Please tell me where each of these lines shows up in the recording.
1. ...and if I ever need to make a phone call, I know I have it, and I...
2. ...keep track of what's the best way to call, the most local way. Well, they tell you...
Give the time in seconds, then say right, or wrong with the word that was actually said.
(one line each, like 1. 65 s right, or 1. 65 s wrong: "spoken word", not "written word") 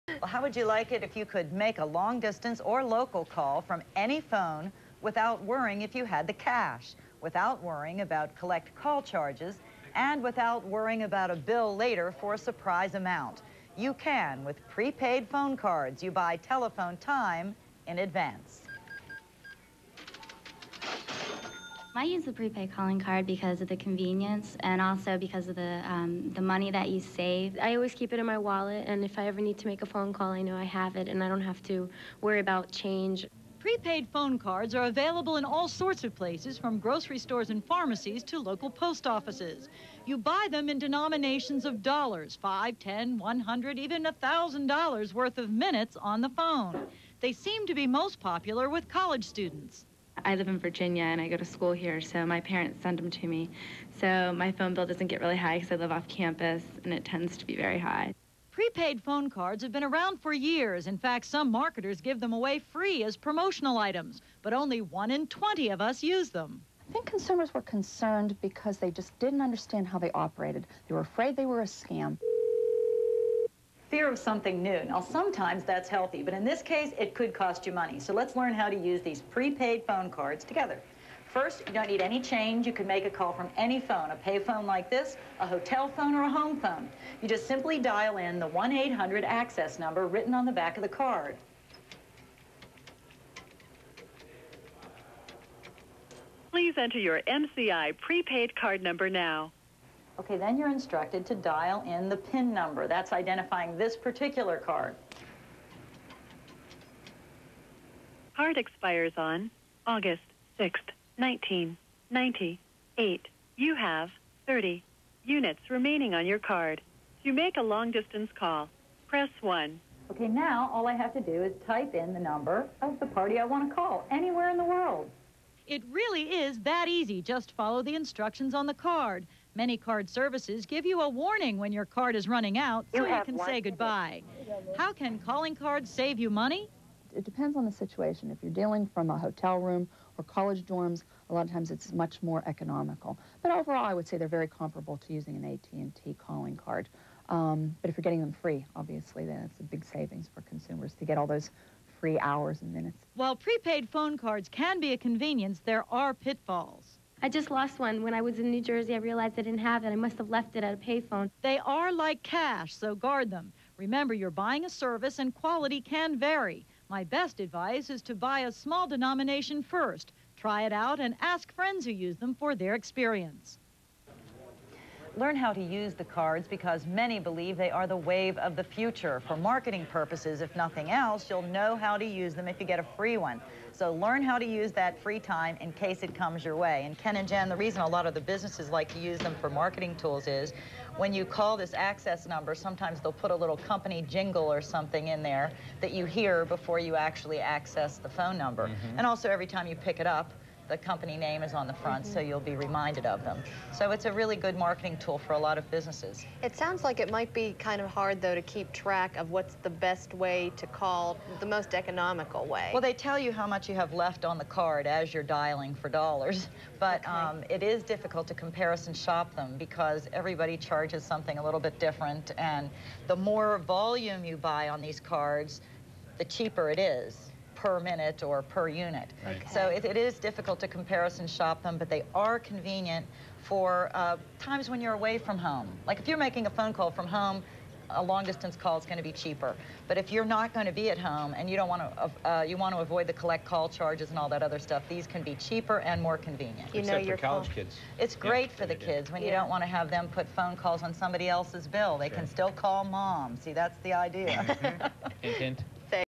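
1. 28 s right
2. 208 s wrong: "economical", not "local".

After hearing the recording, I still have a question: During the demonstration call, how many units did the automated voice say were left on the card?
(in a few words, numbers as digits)
30.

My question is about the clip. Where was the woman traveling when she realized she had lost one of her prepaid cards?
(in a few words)
New Jersey.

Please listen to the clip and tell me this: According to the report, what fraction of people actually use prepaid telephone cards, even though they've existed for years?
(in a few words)
1 in 20.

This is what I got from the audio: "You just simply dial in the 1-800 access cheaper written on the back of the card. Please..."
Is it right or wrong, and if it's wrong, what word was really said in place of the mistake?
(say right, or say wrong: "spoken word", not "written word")
wrong: "number", not "cheaper".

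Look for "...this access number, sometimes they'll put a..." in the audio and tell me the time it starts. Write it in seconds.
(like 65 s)
191 s.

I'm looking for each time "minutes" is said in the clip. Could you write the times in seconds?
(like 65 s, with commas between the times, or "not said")
45 s, 152 s, 227 s.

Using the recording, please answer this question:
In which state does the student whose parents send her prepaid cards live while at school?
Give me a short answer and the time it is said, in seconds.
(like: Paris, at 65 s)
Virginia, at 50 s.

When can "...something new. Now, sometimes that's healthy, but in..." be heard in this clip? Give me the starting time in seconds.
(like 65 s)
74 s.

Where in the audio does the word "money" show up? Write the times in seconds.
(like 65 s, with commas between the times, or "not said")
26 s, 77 s, 136 s.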